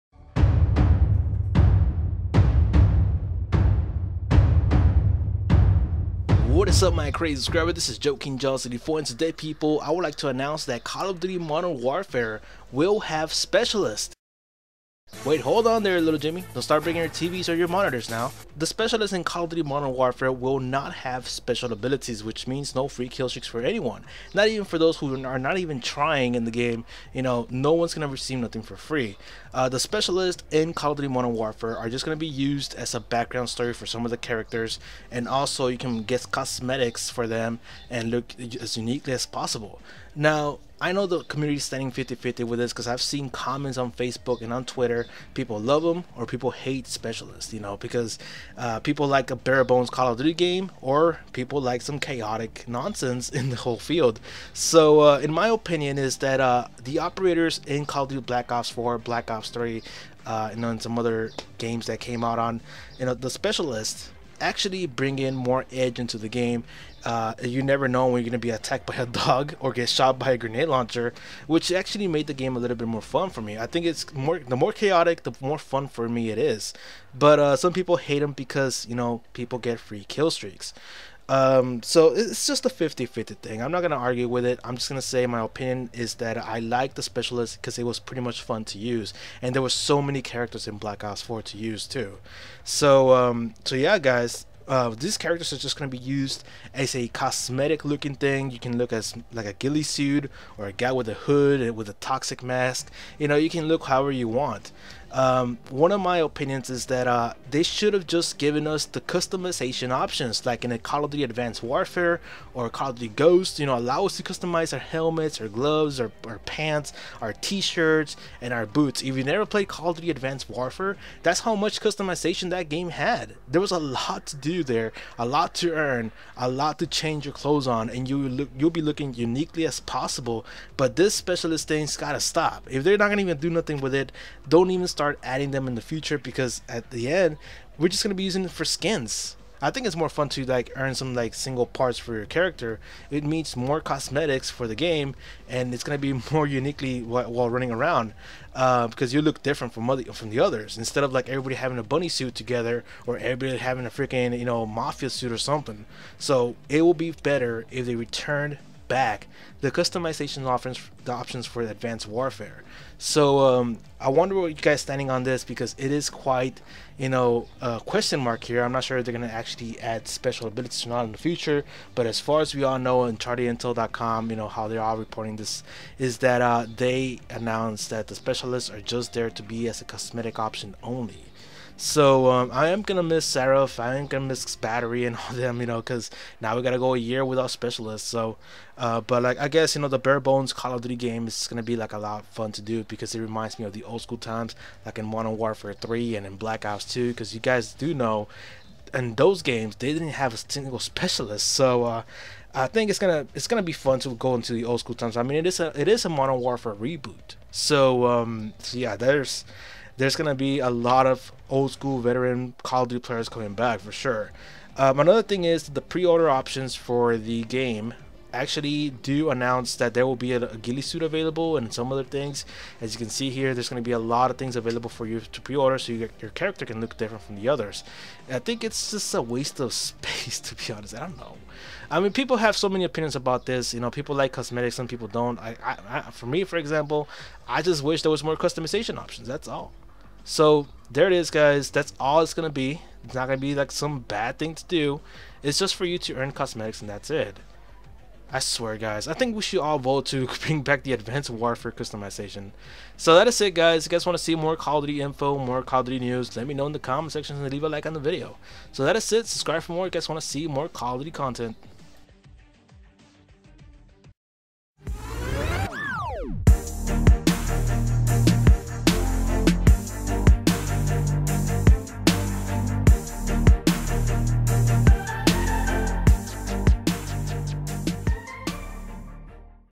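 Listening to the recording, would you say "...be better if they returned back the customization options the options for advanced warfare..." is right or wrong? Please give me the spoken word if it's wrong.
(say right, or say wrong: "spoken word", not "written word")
right.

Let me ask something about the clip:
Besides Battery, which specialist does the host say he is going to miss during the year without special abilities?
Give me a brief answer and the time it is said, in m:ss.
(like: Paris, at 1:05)
Seraph, at 3:03.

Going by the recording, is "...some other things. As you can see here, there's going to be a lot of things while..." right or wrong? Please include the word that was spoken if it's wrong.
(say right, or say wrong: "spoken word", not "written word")
wrong: "available", not "while".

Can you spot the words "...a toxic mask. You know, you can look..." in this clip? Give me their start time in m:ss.
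1:41.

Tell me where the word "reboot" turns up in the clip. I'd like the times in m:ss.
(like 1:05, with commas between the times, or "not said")
3:26.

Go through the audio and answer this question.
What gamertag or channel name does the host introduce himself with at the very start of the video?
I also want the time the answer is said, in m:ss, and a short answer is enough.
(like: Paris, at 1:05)
Joe King Giant 74, at 0:07.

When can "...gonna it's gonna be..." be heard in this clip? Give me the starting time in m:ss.
3:22.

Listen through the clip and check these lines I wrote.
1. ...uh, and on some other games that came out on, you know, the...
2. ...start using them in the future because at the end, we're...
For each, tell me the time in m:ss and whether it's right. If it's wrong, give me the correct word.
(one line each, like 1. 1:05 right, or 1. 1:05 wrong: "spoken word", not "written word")
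1. 1:00 right
2. 2:15 wrong: "adding", not "using".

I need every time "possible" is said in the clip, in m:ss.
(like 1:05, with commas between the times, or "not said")
0:39, 2:09.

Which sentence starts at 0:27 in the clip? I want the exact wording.
You know, no one's gonna receive nothing for free.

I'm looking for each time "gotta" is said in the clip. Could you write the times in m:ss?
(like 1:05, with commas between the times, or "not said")
2:11, 3:06.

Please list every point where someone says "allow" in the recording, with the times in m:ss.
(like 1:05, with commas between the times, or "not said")
1:53.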